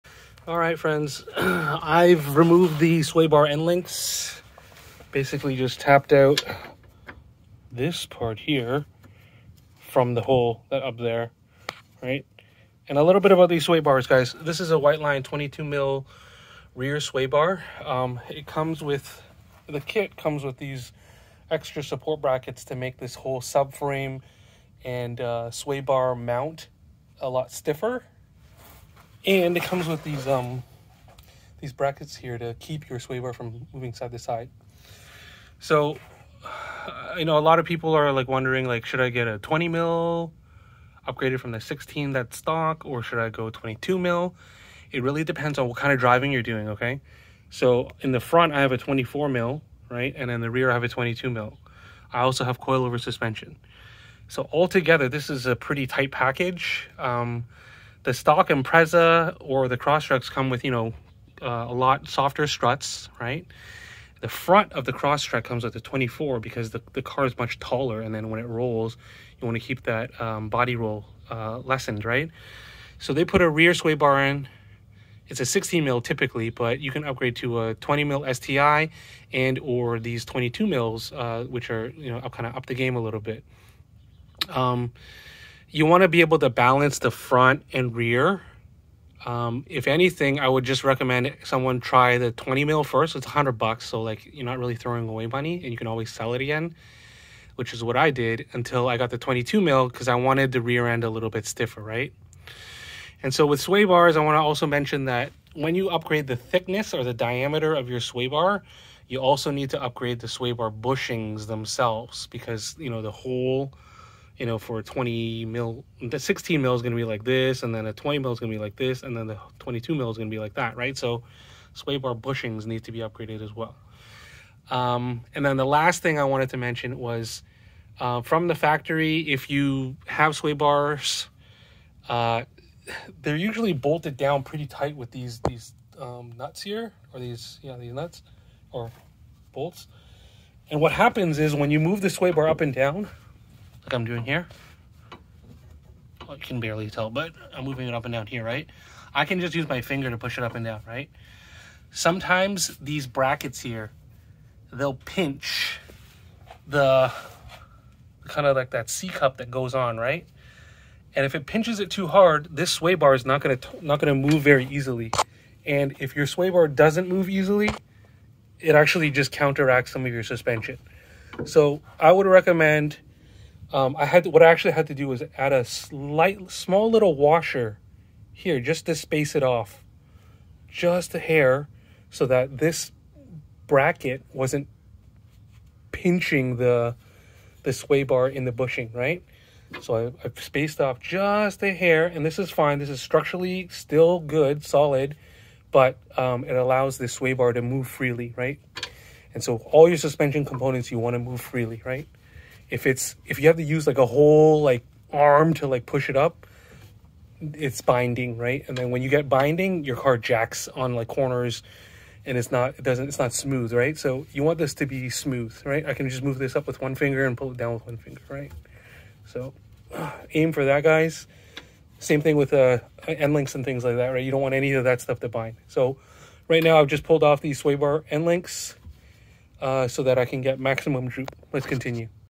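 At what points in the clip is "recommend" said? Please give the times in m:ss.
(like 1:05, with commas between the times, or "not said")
1:30, 2:52.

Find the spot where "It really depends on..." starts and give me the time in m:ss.
0:44.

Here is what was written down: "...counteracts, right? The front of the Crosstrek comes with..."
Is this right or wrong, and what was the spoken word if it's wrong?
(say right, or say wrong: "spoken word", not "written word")
wrong: "struts", not "counteracts".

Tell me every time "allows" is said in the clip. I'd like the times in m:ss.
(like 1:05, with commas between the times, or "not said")
3:16.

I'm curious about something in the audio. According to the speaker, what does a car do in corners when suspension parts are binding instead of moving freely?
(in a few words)
jacks.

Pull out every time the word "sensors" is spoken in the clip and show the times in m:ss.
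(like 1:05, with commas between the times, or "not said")
not said.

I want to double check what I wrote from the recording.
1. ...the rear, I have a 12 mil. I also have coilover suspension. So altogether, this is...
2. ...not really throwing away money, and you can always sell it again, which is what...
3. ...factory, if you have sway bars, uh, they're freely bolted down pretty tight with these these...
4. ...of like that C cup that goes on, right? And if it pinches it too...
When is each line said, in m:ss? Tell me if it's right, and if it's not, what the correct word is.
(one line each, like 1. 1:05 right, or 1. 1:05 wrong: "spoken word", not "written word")
1. 0:50 wrong: "22", not "12"
2. 1:34 right
3. 2:08 wrong: "usually", not "freely"
4. 2:38 right.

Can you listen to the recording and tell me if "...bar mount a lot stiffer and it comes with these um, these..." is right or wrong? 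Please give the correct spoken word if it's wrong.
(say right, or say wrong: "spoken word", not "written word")
right.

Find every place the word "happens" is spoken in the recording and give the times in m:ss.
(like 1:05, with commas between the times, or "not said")
2:20.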